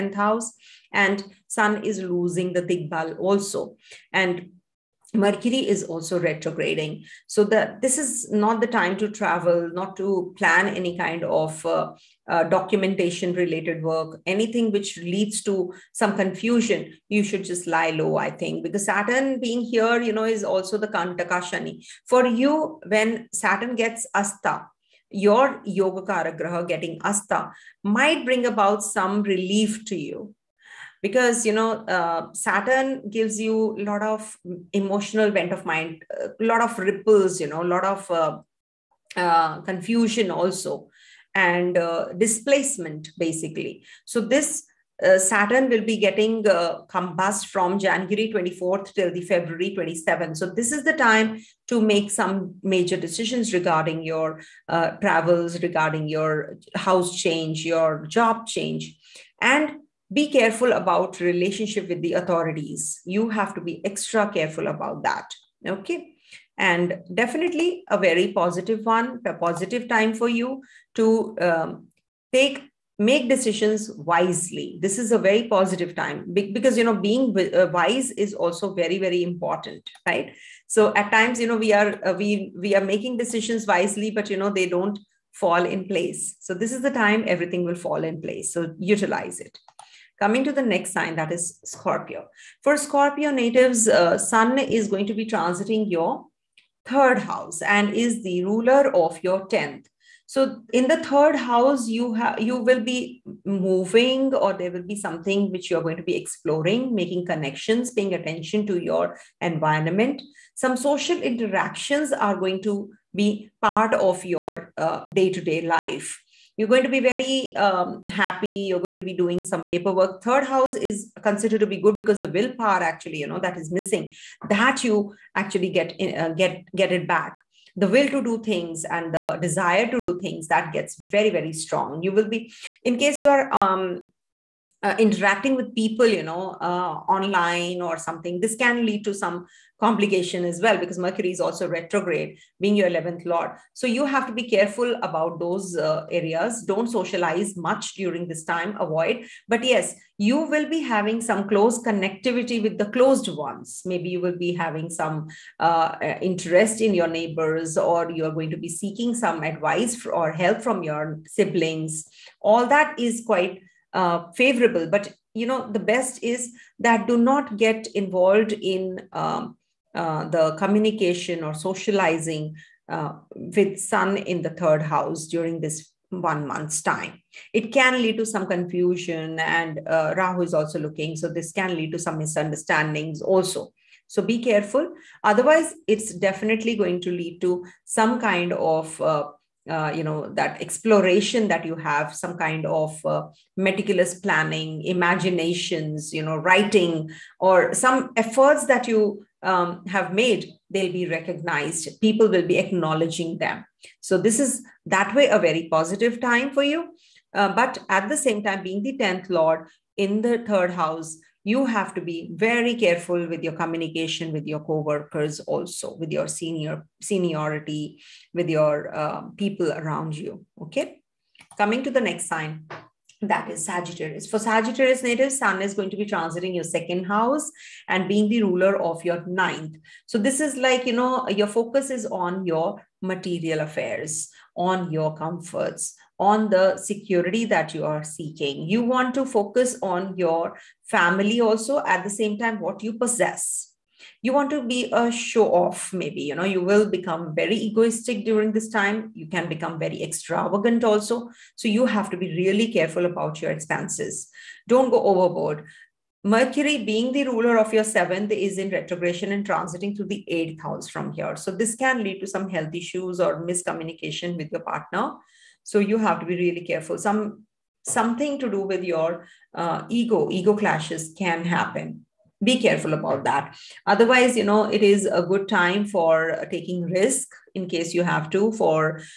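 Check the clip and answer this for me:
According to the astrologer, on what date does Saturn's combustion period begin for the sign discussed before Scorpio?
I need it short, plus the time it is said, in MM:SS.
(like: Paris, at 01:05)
January 24, at 00:47.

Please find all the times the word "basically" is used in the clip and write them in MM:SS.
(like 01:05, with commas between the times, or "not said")
00:43.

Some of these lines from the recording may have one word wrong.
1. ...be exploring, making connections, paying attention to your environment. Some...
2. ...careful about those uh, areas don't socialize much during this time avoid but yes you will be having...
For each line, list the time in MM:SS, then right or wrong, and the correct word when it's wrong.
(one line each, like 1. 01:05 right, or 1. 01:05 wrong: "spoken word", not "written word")
1. 01:46 right
2. 02:24 right.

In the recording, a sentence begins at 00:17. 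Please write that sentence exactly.
You should just lie low, I think, because Saturn being here, you know, is also the Kantaka Shani.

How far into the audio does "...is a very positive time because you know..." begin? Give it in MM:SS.
01:15.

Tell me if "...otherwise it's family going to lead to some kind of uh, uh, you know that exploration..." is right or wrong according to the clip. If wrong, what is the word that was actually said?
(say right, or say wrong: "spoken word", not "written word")
wrong: "definitely", not "family".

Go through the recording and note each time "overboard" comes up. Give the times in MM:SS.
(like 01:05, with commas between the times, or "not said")
04:15.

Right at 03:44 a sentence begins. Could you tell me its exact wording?
For Sagittarius native, Sun is going to be transiting your second house and being the ruler of your ninth.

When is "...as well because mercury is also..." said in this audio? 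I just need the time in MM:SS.
02:20.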